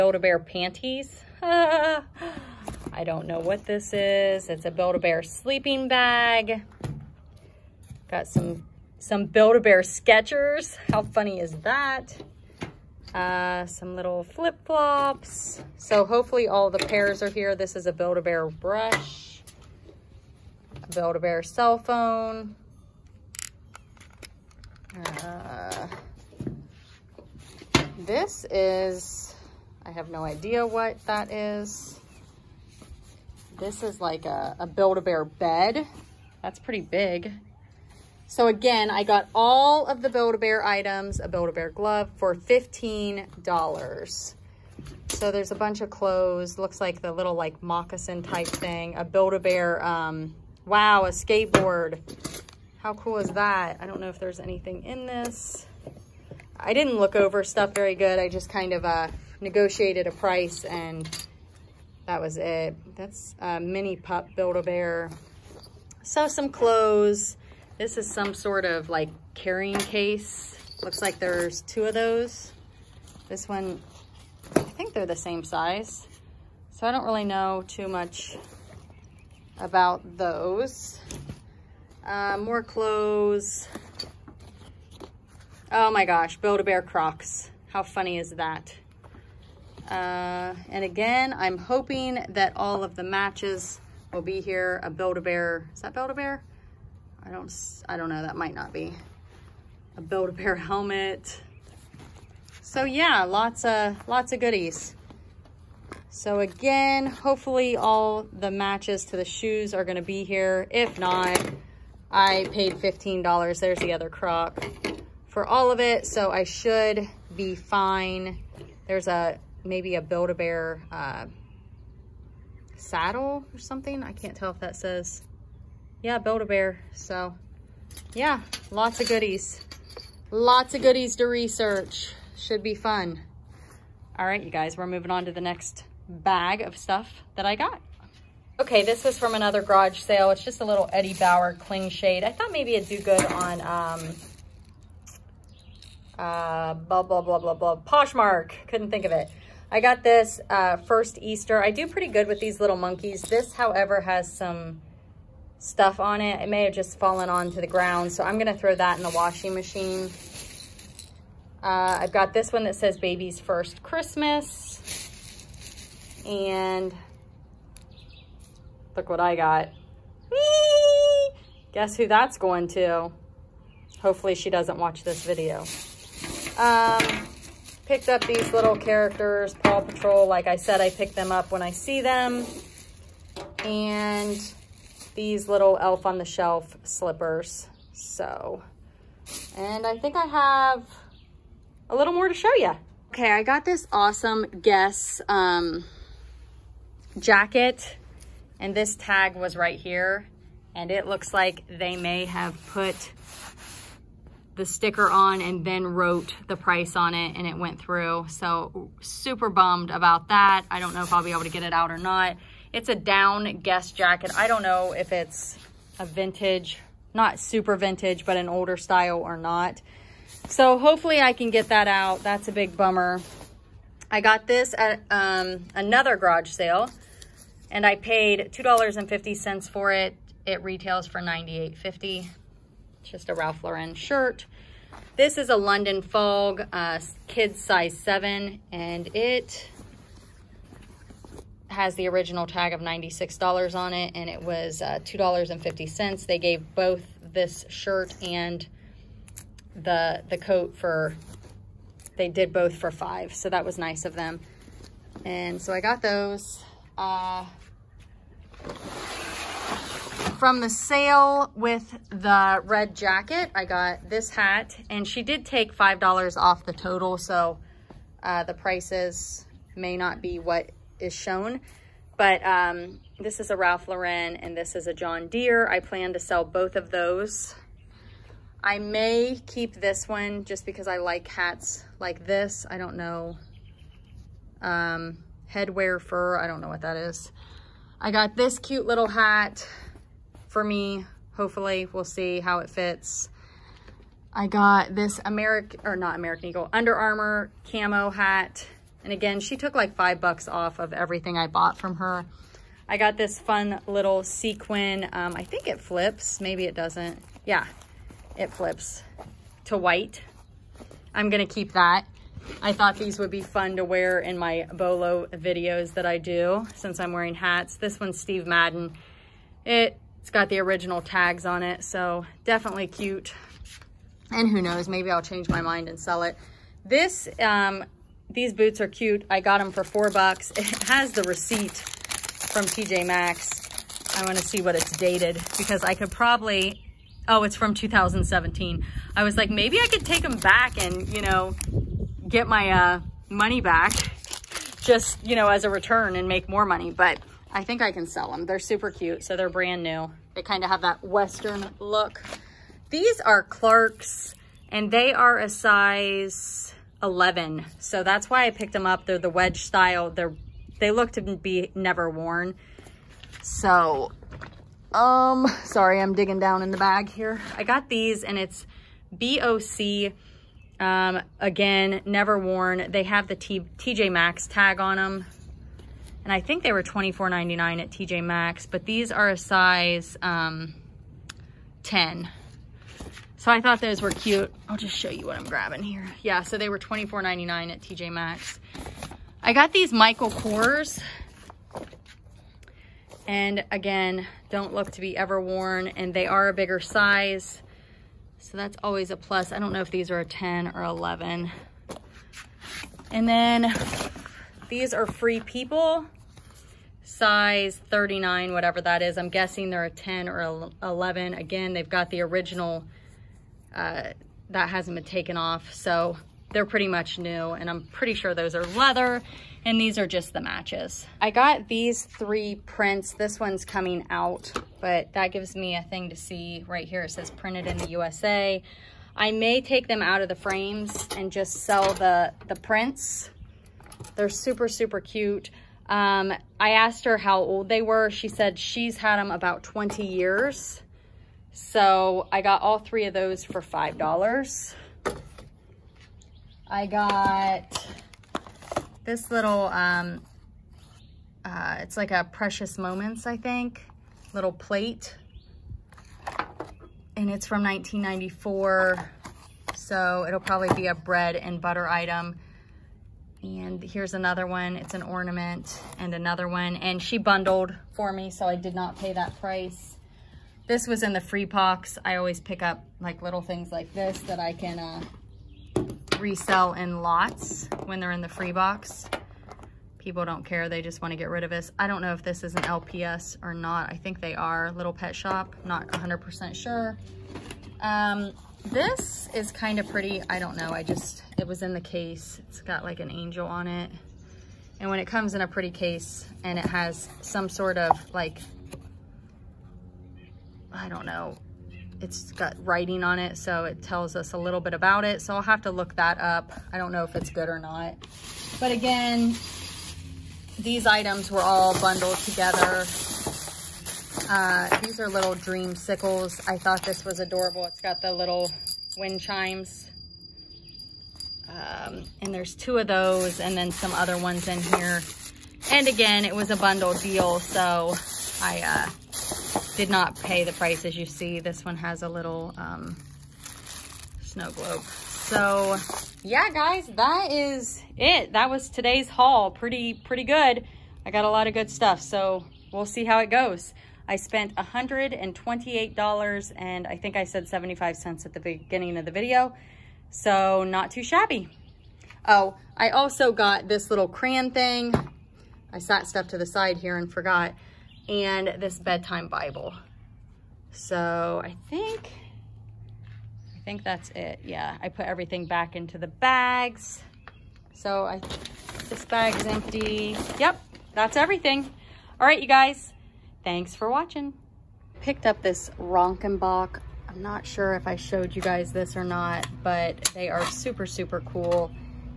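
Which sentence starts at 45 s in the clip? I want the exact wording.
So there's a bunch of clothes.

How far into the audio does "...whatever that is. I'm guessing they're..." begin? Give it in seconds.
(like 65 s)
408 s.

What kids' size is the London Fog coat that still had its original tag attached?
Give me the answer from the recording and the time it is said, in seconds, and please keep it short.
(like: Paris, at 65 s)
7, at 237 s.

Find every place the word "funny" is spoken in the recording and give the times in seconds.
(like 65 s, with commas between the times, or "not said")
11 s, 87 s.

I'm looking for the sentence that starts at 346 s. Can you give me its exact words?
But I think I can sell them.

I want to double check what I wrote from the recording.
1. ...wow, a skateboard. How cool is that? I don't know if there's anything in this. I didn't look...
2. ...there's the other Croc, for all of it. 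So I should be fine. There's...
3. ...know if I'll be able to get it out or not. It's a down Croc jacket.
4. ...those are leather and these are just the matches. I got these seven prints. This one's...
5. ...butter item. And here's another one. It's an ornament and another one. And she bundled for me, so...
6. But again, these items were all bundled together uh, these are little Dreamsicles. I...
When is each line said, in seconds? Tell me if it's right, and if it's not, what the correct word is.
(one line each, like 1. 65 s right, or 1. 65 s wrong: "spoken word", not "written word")
1. 50 s right
2. 113 s right
3. 210 s wrong: "Guess", not "Croc"
4. 418 s wrong: "three", not "seven"
5. 461 s right
6. 508 s right.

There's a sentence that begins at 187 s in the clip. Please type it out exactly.
So, and I think I have a little more to show you.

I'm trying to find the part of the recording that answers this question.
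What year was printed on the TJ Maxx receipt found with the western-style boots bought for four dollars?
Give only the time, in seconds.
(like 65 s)
337 s.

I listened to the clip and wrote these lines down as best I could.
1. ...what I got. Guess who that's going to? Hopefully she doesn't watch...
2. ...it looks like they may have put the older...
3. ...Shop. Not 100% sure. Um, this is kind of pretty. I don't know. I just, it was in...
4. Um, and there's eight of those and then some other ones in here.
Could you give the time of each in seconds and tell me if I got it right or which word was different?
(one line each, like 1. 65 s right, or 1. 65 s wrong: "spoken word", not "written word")
1. 169 s right
2. 200 s wrong: "sticker", not "older"
3. 485 s right
4. 521 s wrong: "two", not "eight".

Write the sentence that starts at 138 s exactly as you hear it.
Okay, this was from another garage sale.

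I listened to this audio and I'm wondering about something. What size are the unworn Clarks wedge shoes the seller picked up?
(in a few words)
11.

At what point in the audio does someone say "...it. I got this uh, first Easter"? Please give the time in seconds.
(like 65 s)
149 s.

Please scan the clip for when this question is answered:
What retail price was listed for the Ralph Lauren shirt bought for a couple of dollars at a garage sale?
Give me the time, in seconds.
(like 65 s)
231 s.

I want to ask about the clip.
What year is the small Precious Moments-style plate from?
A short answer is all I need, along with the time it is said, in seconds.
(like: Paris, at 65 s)
1994, at 457 s.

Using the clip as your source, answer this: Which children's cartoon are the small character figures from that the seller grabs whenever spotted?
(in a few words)
Paw Patrol.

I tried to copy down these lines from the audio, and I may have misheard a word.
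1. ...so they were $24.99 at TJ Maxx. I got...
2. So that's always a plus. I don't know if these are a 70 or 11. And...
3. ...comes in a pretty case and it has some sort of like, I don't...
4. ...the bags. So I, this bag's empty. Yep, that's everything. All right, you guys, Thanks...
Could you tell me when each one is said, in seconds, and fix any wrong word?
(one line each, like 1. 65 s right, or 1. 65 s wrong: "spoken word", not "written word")
1. 386 s right
2. 398 s wrong: "10", not "70"
3. 495 s right
4. 565 s right.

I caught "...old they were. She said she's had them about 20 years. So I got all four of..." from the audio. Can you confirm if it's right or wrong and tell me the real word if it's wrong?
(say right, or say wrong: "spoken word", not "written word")
wrong: "three", not "four".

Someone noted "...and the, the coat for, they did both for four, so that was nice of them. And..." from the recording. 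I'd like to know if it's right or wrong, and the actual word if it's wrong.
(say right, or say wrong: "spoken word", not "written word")
wrong: "five", not "four".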